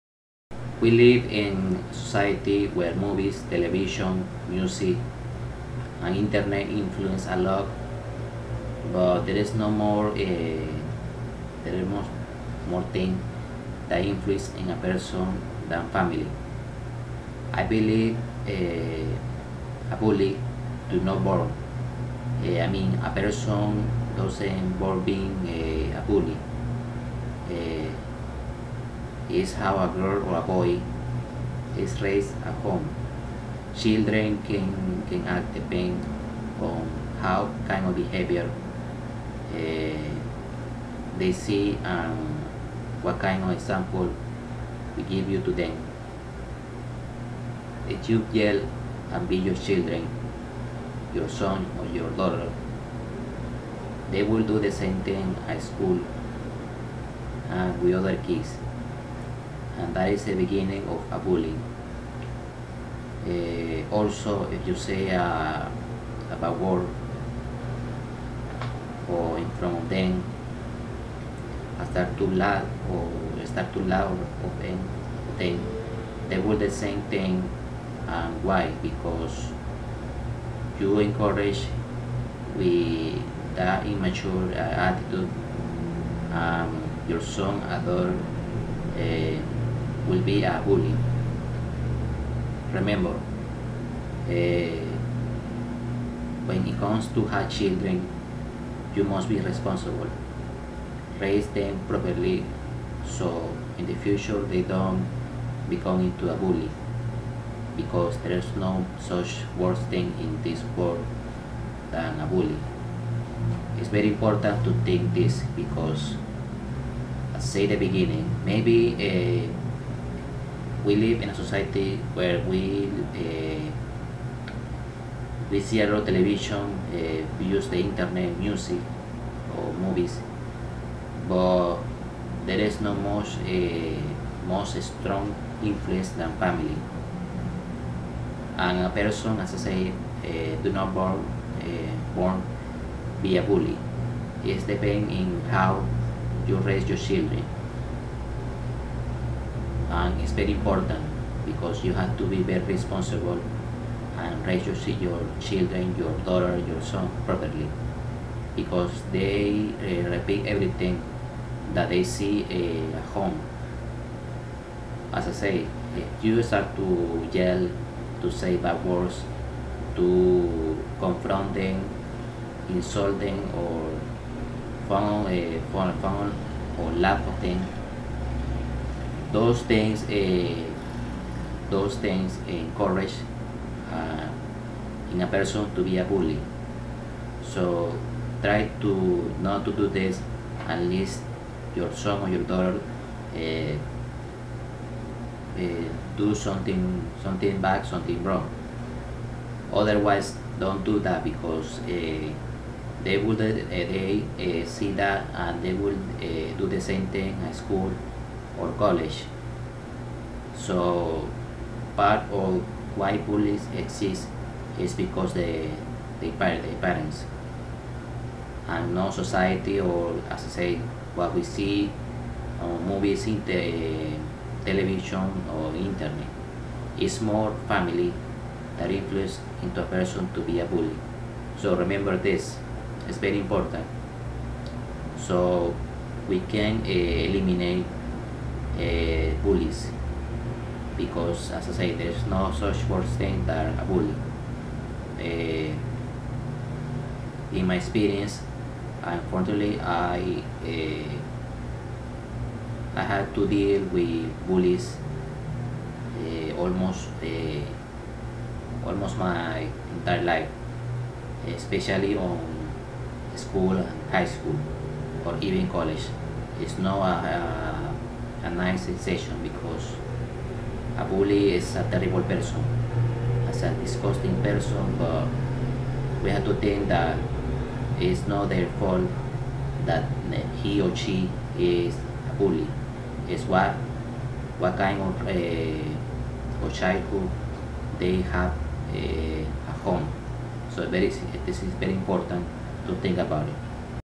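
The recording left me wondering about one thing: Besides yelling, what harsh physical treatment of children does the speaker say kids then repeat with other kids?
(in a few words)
beat.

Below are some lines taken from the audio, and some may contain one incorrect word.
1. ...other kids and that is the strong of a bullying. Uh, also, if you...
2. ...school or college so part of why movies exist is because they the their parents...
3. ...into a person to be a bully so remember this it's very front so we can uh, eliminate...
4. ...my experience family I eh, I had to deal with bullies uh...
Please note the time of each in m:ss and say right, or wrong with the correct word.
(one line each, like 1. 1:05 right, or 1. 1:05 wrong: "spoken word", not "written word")
1. 0:57 wrong: "beginning", not "strong"
2. 3:27 wrong: "bullies", not "movies"
3. 3:49 wrong: "important", not "front"
4. 4:07 wrong: "unfortunately", not "family".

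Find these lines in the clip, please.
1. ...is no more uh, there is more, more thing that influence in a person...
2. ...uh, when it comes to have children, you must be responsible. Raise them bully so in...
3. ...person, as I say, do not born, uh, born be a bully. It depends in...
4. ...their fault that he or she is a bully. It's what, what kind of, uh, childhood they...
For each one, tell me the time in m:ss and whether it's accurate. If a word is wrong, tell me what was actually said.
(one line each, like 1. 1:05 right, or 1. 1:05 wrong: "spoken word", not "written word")
1. 0:09 right
2. 1:34 wrong: "properly", not "bully"
3. 2:18 right
4. 4:38 right.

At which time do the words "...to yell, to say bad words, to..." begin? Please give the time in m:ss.
2:46.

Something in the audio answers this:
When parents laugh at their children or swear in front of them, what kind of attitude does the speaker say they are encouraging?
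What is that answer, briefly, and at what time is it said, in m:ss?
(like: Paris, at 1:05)
immature, at 1:23.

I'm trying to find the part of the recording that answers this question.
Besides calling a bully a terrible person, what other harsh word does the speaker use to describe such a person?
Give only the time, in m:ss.
4:33.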